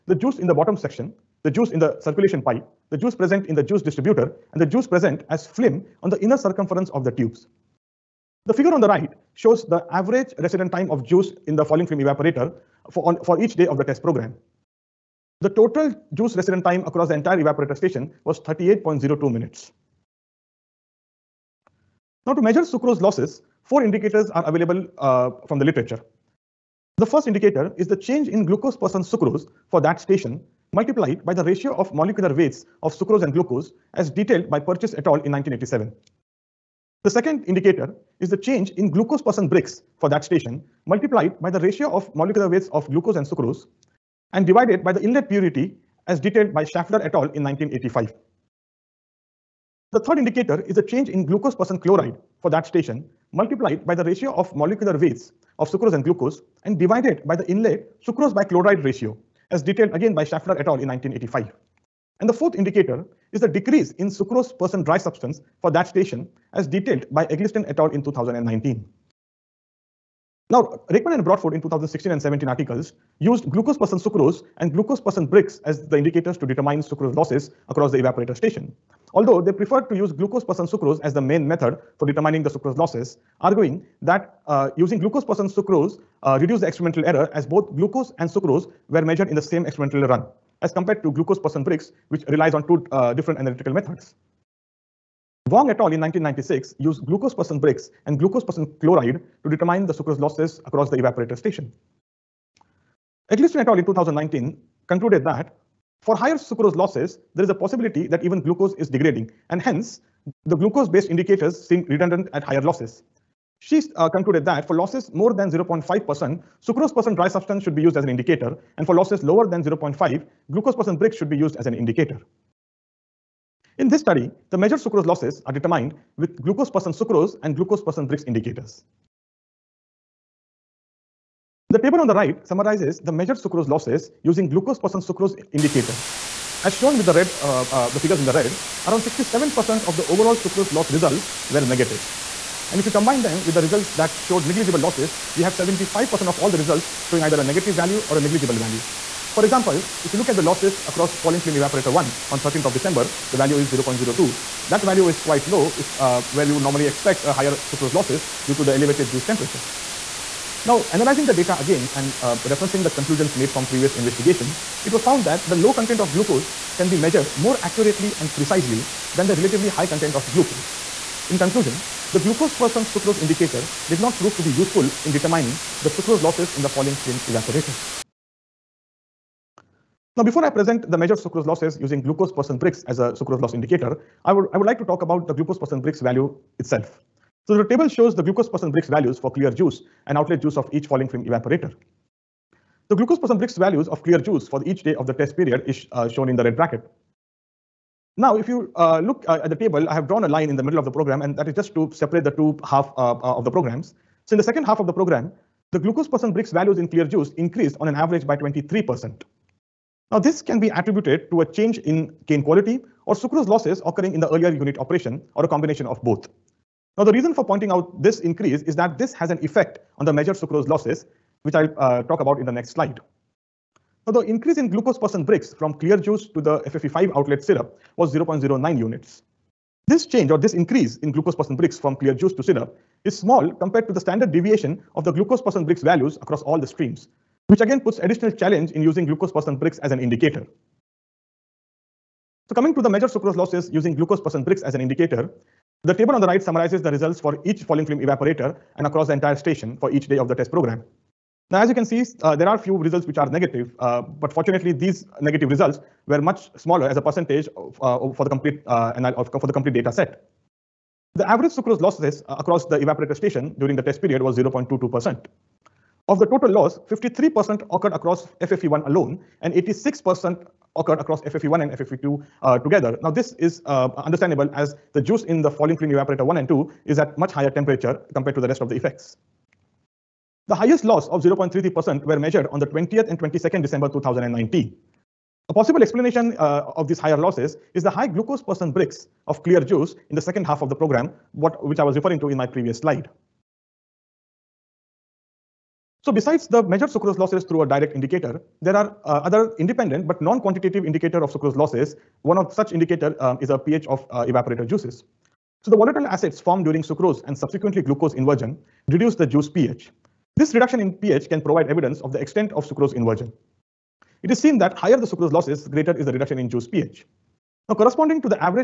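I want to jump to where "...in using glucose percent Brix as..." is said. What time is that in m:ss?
3:58.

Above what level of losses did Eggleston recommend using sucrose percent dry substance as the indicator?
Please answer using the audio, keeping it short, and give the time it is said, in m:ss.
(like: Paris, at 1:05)
0.5%, at 1:55.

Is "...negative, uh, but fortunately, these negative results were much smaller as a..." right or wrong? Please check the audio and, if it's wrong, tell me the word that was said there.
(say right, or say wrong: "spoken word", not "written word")
right.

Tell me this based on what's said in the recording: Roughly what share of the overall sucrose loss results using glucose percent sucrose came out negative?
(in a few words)
67%.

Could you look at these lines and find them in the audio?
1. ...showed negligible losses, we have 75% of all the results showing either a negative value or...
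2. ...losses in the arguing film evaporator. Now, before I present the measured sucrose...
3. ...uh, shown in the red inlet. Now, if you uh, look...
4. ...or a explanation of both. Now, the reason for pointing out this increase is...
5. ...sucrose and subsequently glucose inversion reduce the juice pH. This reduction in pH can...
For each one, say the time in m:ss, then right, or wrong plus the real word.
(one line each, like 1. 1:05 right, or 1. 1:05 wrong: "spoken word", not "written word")
1. 2:24 right
2. 2:56 wrong: "falling", not "arguing"
3. 3:15 wrong: "bracket", not "inlet"
4. 3:35 wrong: "combination", not "explanation"
5. 5:06 right.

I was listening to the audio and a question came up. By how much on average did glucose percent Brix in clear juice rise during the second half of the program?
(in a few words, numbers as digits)
23%.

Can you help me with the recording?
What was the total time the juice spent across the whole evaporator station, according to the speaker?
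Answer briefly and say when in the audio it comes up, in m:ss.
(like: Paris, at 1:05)
38.02 minutes, at 0:18.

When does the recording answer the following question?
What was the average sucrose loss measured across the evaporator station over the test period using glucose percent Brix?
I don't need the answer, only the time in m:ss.
4:24.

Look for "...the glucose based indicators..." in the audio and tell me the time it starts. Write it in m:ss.
1:50.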